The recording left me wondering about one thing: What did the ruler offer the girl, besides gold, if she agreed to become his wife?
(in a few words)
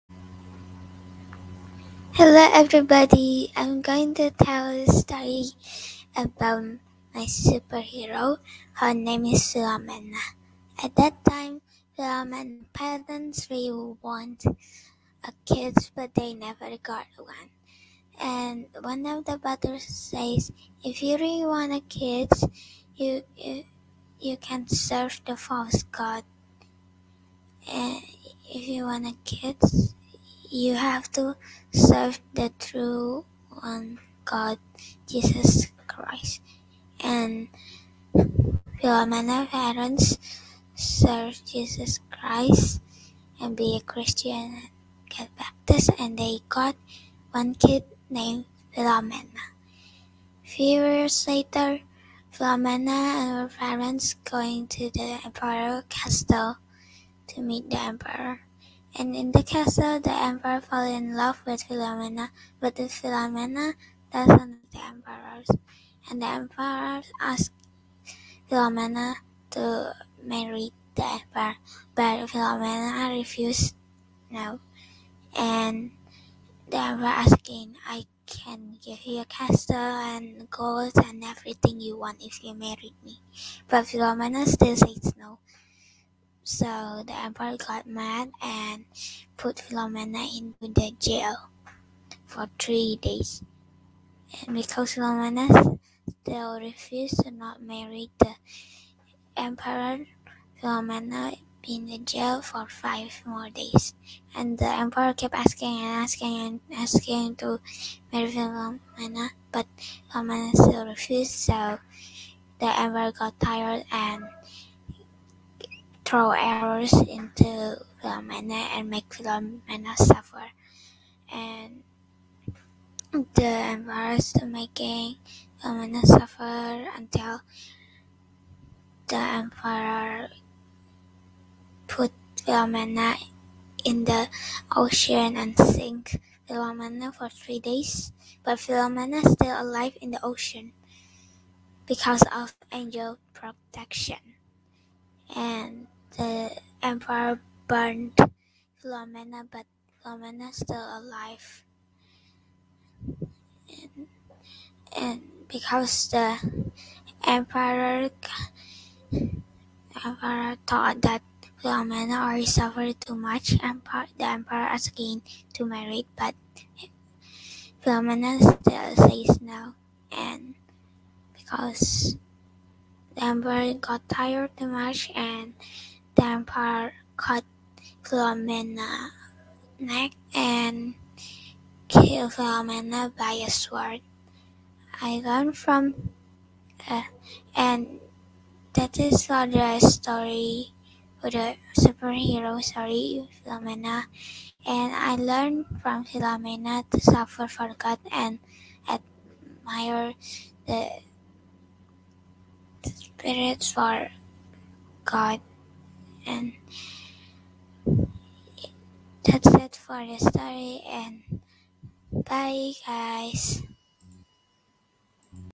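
A castle.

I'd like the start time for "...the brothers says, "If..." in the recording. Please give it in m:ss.
0:19.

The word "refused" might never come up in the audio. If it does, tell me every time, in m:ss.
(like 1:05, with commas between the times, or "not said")
1:13, 1:36, 1:50.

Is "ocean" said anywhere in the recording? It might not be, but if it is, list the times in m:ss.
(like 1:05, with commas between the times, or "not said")
2:14, 2:20.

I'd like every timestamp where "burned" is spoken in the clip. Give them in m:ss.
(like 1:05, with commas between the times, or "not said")
2:27.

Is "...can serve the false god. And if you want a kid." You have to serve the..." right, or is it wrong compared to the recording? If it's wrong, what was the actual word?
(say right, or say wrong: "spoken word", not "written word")
right.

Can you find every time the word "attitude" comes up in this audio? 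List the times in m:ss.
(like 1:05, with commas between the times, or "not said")
not said.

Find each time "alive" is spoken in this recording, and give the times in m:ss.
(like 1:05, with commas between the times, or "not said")
2:19, 2:30.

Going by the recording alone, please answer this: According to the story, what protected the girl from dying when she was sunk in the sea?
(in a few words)
Angel protection.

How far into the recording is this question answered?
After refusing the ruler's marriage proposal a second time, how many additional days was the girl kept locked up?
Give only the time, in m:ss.
1:42.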